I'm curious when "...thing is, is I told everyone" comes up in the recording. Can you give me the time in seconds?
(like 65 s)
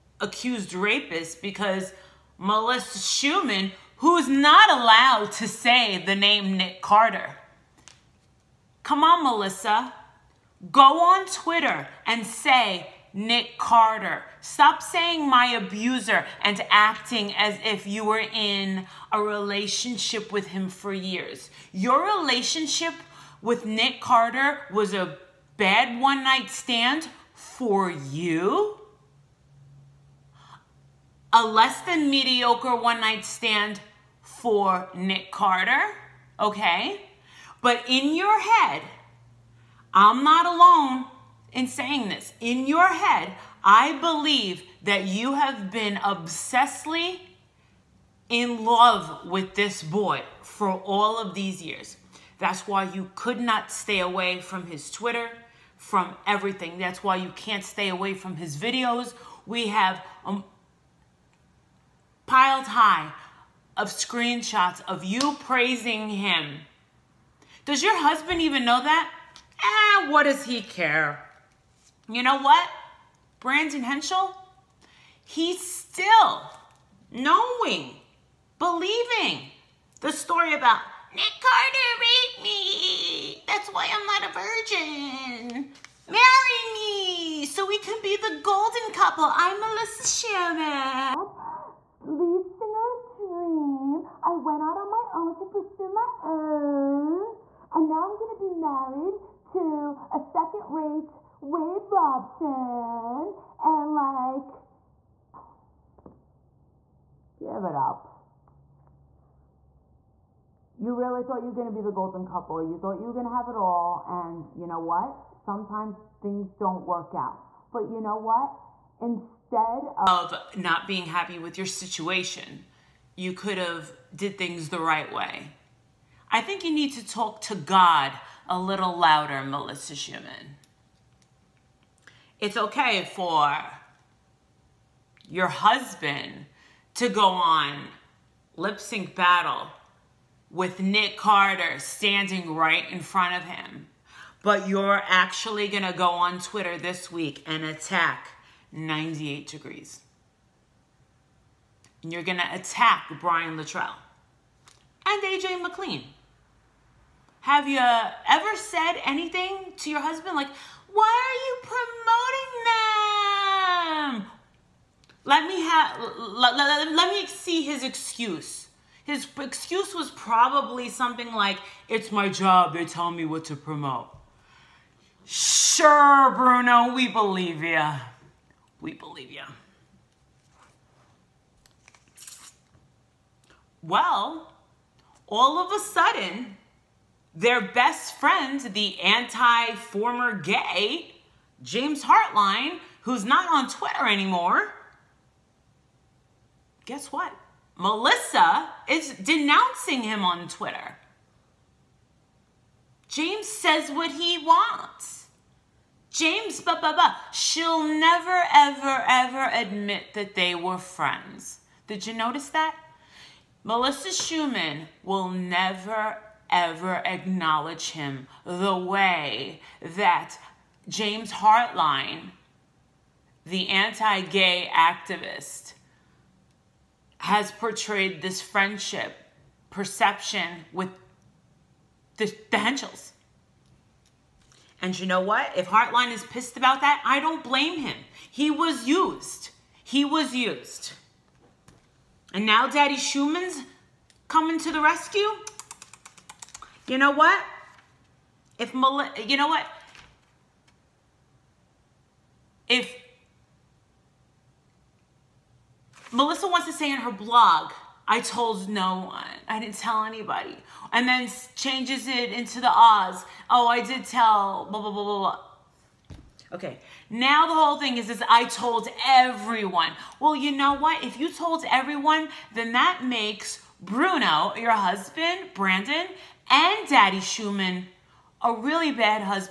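267 s.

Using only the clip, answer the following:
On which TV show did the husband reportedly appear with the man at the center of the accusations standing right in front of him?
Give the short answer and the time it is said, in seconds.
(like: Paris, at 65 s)
Lip Sync Battle, at 138 s.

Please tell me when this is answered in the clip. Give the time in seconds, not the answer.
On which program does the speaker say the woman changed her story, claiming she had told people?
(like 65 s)
262 s.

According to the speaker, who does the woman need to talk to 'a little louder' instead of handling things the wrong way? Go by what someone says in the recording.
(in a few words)
God.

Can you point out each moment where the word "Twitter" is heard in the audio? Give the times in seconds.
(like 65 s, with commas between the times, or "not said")
11 s, 54 s, 146 s, 193 s, 200 s.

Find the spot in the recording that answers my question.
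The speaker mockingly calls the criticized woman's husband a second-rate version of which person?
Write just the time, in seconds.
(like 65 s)
101 s.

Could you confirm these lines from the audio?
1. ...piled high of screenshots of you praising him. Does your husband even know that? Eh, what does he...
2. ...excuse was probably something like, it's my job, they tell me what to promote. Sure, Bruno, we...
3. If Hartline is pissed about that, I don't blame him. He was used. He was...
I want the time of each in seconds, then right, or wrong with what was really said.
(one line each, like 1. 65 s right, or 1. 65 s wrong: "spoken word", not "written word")
1. 62 s right
2. 169 s right
3. 235 s right.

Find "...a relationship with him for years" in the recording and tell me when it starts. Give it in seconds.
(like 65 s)
19 s.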